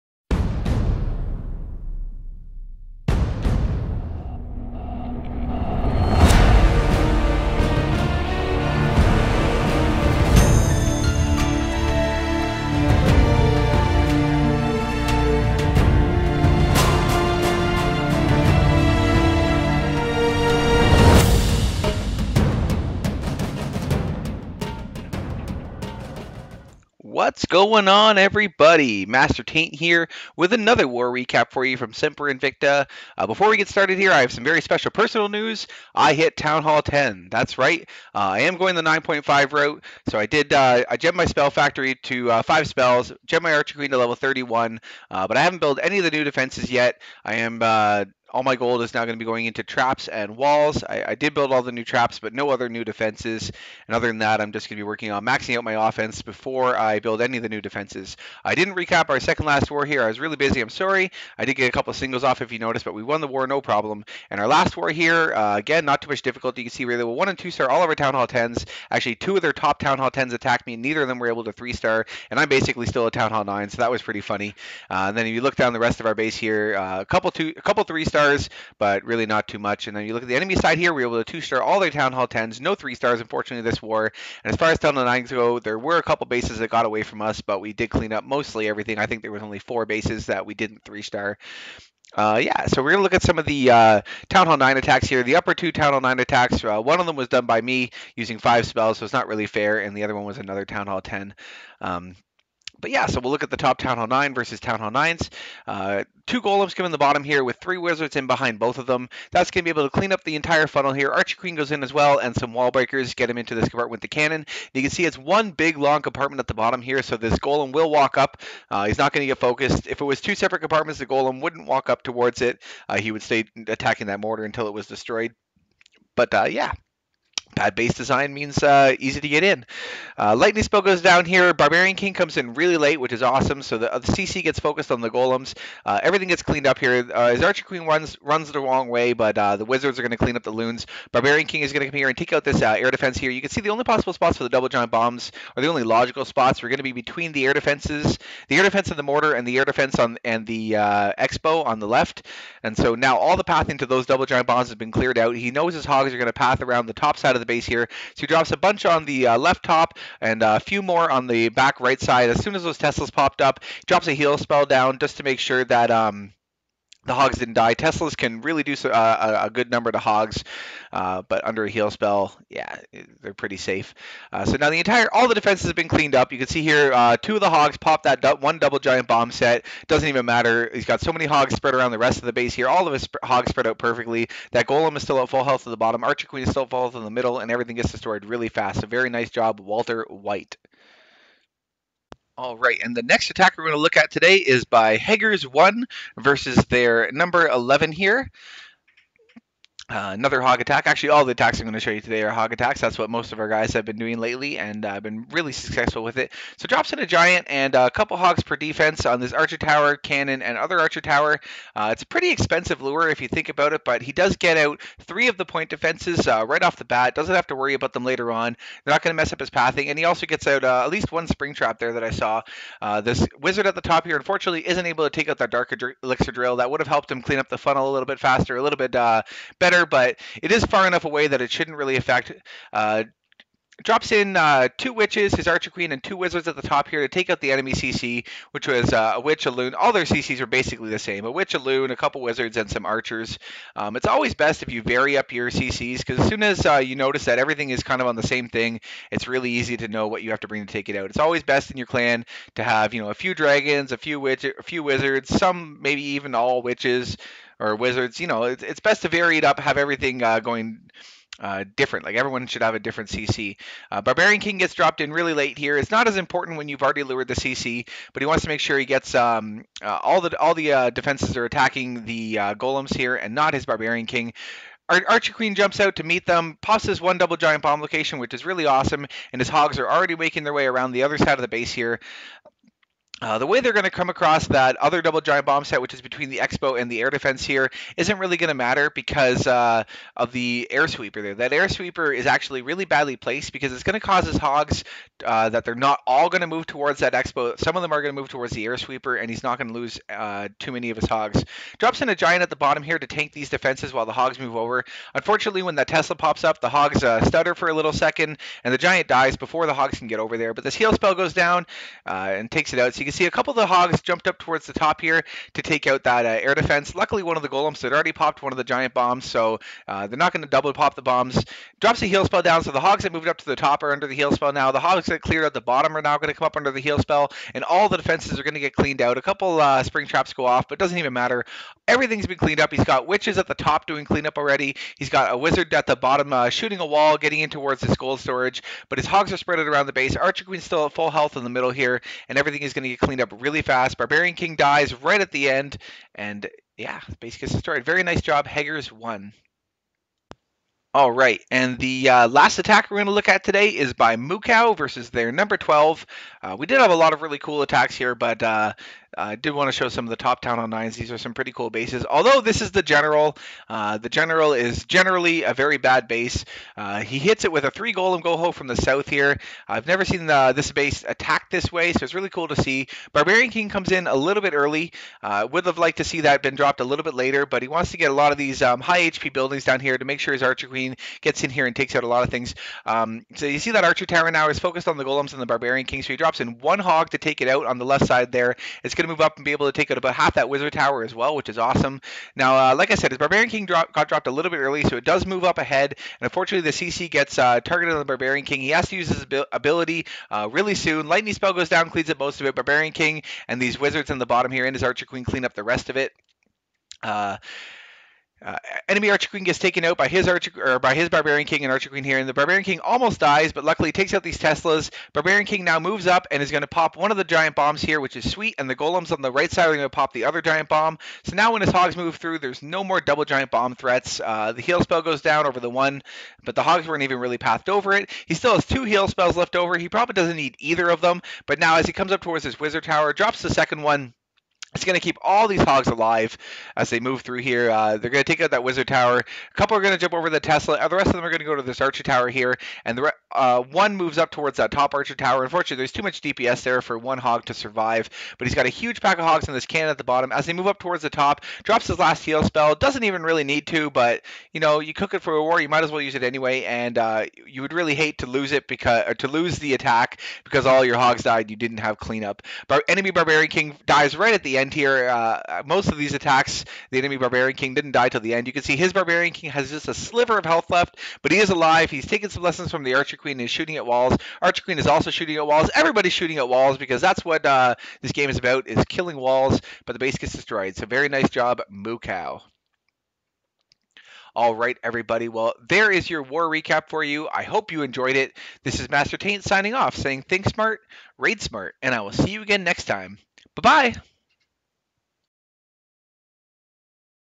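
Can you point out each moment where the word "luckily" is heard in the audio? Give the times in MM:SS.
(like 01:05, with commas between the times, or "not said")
05:16, 06:53.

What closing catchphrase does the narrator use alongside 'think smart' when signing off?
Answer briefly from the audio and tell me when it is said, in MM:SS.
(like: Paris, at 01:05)
raid smart, at 08:11.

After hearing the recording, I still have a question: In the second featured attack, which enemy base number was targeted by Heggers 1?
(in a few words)
11.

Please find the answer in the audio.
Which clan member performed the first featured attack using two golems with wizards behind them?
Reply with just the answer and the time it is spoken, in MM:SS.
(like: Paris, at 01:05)
Walter White, at 03:09.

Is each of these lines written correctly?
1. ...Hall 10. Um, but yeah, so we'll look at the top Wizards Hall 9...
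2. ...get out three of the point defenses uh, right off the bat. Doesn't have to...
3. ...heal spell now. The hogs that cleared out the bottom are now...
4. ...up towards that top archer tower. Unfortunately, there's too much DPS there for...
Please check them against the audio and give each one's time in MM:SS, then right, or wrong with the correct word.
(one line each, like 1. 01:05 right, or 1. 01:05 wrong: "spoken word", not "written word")
1. 01:40 wrong: "Town", not "Wizards"
2. 03:34 right
3. 05:24 right
4. 07:24 right.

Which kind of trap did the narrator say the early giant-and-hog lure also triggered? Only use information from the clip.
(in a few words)
spring trap.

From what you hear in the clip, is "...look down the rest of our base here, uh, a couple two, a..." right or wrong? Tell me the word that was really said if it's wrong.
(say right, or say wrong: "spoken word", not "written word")
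right.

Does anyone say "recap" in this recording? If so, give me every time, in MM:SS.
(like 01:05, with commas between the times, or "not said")
00:31, 00:58, 08:06.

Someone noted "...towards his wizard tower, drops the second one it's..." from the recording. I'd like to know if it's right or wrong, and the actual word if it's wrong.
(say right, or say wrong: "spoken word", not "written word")
right.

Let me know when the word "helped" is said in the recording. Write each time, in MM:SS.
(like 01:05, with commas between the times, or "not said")
03:46.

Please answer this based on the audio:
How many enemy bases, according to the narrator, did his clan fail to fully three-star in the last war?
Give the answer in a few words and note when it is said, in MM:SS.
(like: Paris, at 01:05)
4, at 01:29.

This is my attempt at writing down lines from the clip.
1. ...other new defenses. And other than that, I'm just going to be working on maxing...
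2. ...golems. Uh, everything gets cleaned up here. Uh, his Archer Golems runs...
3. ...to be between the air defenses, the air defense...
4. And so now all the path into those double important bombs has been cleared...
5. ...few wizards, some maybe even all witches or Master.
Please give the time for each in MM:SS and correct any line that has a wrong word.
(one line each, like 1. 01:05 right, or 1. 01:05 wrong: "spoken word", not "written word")
1. 00:52 right
2. 02:15 wrong: "Queen", not "Golems"
3. 02:26 right
4. 02:32 wrong: "giant", not "important"
5. 04:14 wrong: "Wizards", not "Master".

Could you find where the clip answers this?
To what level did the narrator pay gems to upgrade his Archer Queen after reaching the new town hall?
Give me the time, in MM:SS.
00:43.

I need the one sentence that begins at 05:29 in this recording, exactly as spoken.
A couple uh, spring traps go off, but doesn't even matter.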